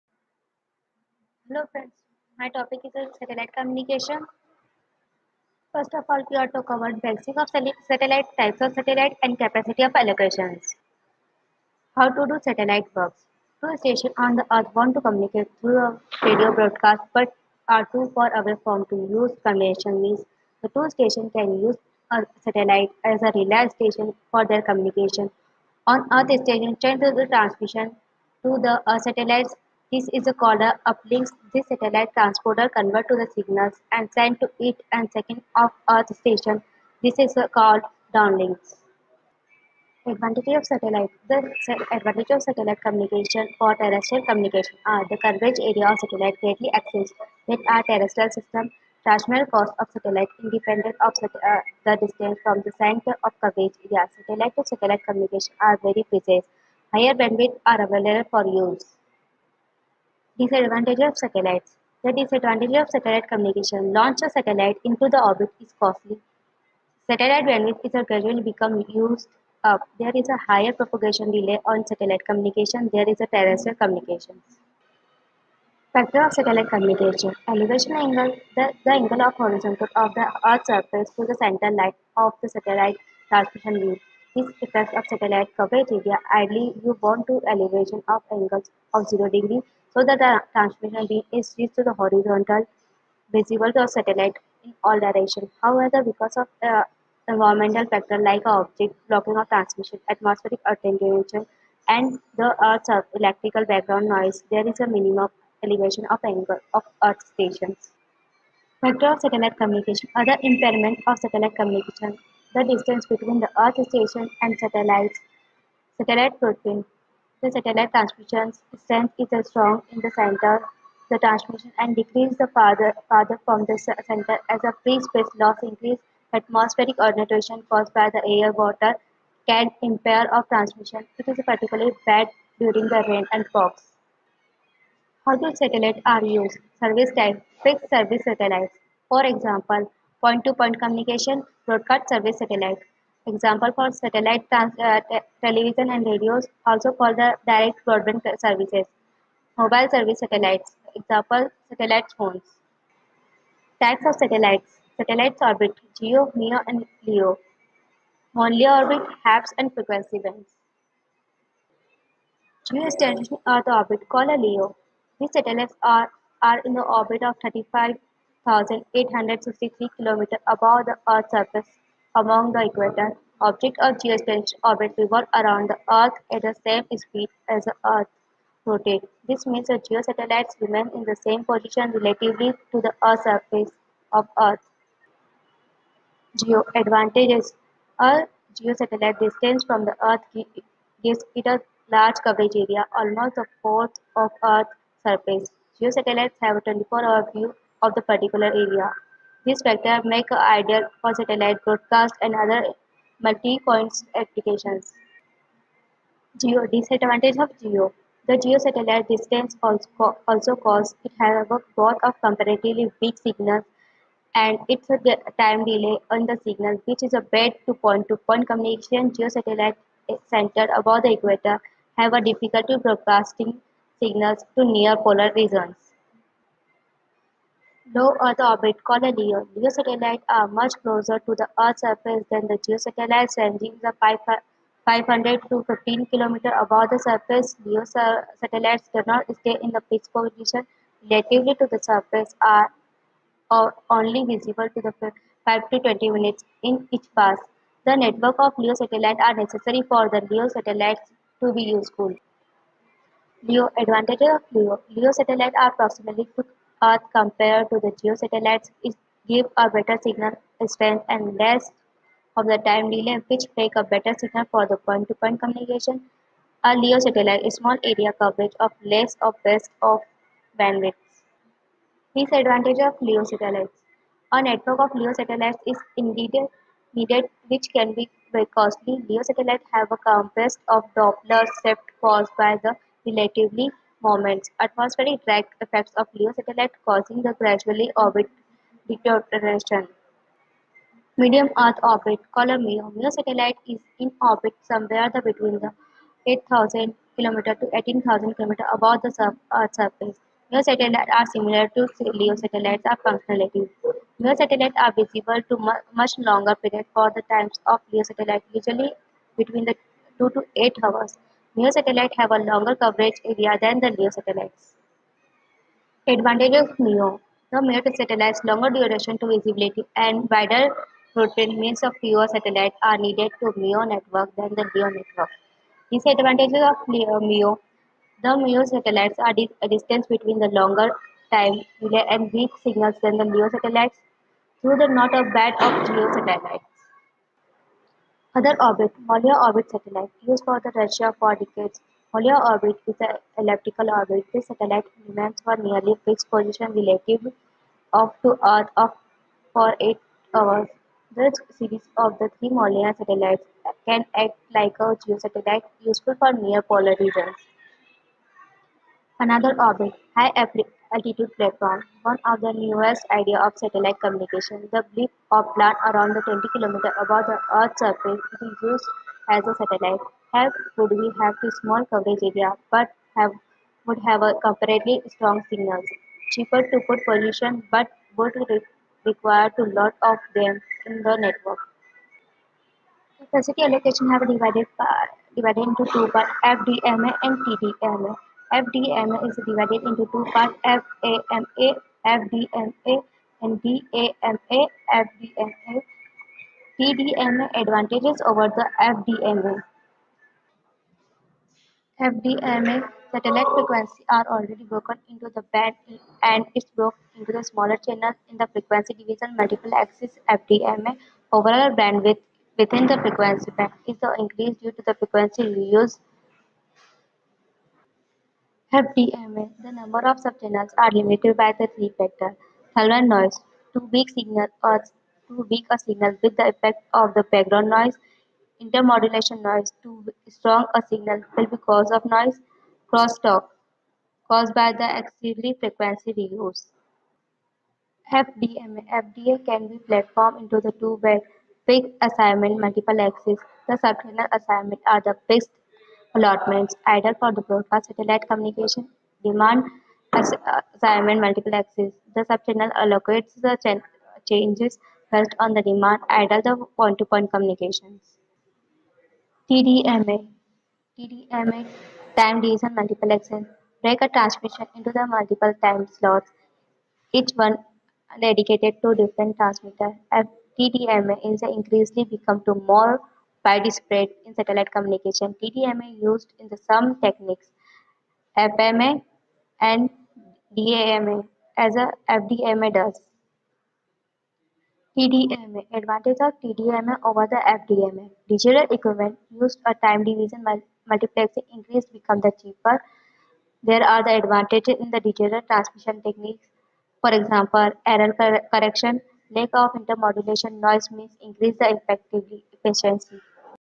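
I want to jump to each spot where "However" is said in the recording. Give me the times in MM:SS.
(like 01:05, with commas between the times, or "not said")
01:35.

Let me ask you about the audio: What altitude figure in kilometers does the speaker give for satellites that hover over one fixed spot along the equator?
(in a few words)
35,863 km.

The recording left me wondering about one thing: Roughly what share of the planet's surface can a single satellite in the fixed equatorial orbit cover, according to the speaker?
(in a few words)
a fourth.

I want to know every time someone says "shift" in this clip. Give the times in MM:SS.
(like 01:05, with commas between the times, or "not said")
04:41.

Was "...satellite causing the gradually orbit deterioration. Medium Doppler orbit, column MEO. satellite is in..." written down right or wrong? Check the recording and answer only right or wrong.
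wrong.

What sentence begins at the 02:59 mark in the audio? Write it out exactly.
This means the geosatellites remain in the same position relatively to the Earth's surface of Earth.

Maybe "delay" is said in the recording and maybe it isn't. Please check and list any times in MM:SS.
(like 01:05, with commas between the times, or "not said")
01:11, 03:35, 04:22, 05:31.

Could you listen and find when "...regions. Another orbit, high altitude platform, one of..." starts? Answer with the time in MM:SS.
05:57.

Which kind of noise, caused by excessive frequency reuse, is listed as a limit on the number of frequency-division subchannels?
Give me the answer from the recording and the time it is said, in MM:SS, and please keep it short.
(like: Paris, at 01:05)
crosstalk, at 07:12.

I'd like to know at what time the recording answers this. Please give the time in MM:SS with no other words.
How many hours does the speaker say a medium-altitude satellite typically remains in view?
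05:10.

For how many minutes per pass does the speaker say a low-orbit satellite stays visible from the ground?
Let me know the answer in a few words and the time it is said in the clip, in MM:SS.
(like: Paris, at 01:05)
5 to 20 minutes, at 04:05.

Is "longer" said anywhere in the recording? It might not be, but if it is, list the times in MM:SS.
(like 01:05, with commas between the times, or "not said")
05:06, 05:12, 05:18, 05:30.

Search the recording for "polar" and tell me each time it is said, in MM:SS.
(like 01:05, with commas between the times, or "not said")
03:44, 05:56.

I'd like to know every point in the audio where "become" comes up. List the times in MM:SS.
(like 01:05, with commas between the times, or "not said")
01:08, 07:52, 08:11.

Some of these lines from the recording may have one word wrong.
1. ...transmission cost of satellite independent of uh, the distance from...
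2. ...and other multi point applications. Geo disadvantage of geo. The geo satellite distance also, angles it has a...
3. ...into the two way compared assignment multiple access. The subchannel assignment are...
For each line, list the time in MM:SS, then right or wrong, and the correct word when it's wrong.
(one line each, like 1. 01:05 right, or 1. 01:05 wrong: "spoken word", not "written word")
1. 00:49 right
2. 03:22 wrong: "causes", not "angles"
3. 07:20 wrong: "fixed", not "compared".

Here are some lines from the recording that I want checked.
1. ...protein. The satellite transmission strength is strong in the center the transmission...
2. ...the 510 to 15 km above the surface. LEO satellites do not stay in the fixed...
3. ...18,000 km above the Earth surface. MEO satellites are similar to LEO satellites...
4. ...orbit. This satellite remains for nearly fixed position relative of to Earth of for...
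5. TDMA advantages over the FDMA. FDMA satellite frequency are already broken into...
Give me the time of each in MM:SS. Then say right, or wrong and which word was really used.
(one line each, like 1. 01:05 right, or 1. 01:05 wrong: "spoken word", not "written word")
1. 01:56 right
2. 03:53 wrong: "500", not "510"
3. 04:57 right
4. 05:43 right
5. 06:36 right.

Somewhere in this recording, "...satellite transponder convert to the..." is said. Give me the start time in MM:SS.
00:31.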